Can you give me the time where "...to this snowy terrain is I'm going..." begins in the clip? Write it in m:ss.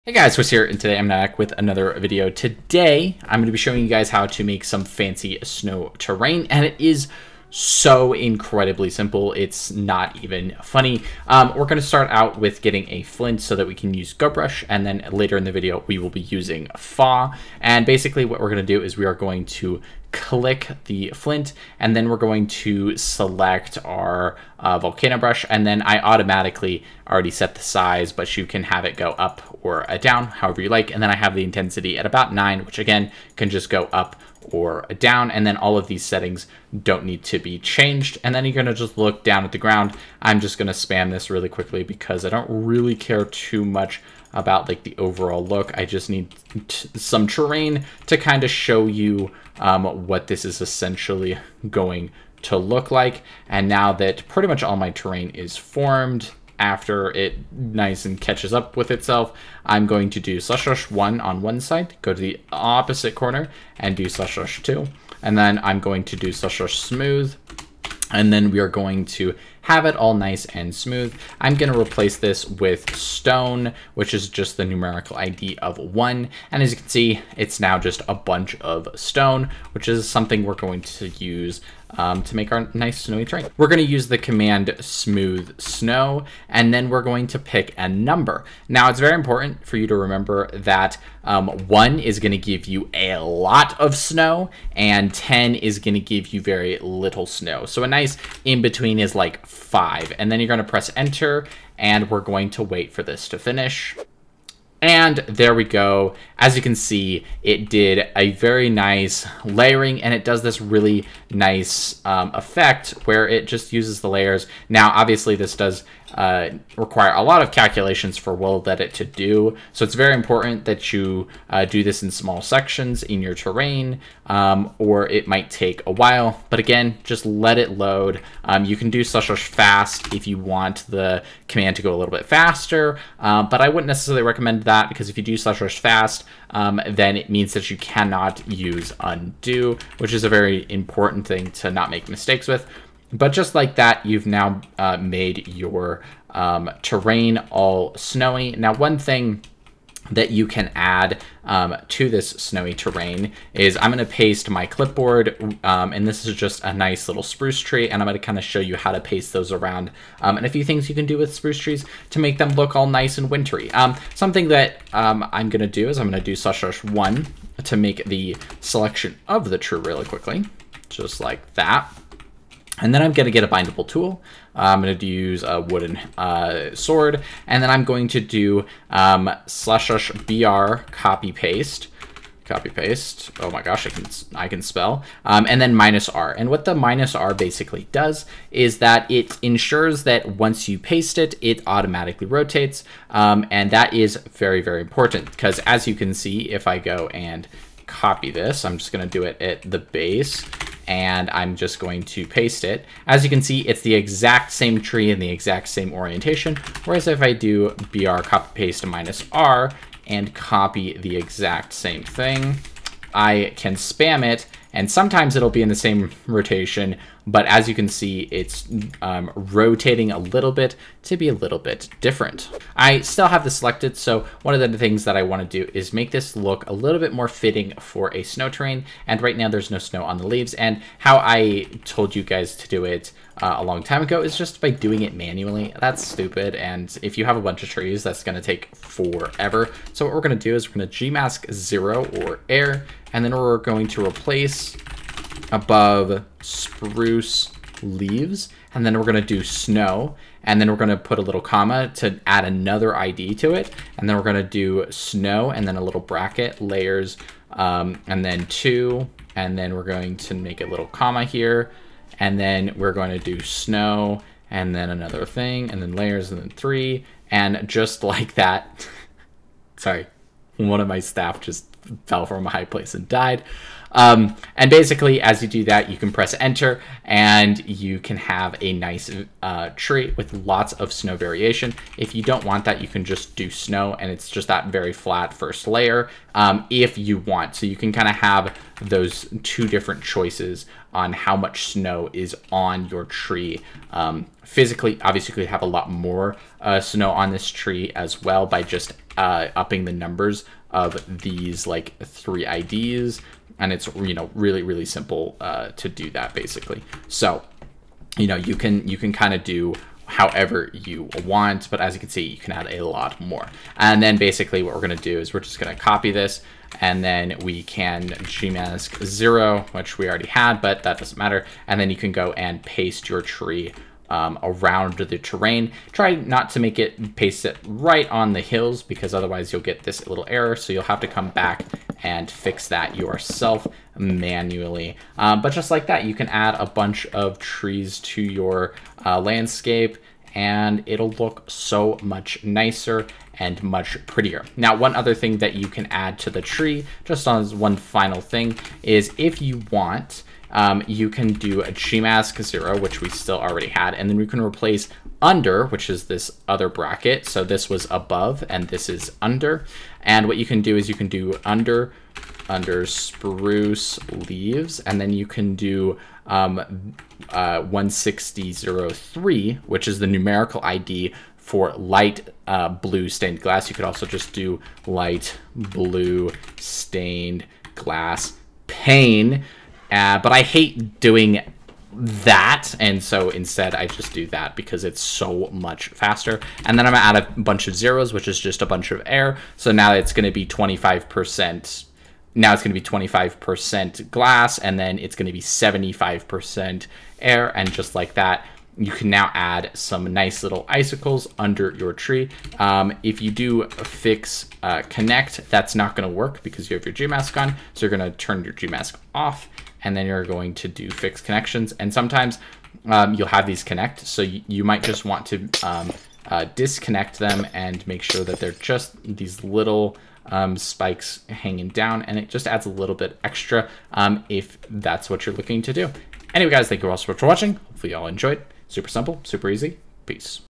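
2:31.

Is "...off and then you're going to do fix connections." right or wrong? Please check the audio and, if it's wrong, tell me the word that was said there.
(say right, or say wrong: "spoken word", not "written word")
right.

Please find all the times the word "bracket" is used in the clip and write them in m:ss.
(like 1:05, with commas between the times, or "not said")
4:16, 5:56.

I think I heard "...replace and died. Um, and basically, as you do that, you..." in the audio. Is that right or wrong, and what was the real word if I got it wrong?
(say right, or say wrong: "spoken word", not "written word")
wrong: "place", not "replace".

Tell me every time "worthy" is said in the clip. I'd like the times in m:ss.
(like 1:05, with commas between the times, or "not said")
not said.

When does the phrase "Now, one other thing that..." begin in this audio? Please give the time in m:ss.
5:44.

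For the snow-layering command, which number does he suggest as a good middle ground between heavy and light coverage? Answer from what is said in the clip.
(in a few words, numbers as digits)
5.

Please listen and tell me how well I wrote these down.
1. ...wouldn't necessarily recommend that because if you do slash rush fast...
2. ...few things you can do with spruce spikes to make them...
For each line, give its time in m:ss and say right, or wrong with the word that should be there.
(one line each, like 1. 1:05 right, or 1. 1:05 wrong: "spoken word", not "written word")
1. 2:13 right
2. 2:40 wrong: "trees", not "spikes".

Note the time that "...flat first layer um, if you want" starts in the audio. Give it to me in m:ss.
4:44.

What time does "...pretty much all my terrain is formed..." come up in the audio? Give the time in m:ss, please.
0:54.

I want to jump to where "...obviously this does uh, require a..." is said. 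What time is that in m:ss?
1:54.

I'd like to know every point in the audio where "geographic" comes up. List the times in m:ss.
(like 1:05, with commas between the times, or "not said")
not said.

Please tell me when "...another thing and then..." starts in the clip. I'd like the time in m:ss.
4:24.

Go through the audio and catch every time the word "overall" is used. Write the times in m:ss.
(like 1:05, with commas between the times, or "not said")
0:44.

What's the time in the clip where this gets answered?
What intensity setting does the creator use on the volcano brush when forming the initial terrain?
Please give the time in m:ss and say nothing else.
0:32.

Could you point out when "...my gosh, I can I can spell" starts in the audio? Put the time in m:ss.
3:03.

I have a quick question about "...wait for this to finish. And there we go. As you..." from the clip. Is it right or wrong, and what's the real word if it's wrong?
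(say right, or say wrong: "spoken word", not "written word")
right.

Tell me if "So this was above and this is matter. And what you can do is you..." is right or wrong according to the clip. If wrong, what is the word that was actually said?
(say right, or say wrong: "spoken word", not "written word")
wrong: "under", not "matter".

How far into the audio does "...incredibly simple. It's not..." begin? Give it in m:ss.
0:08.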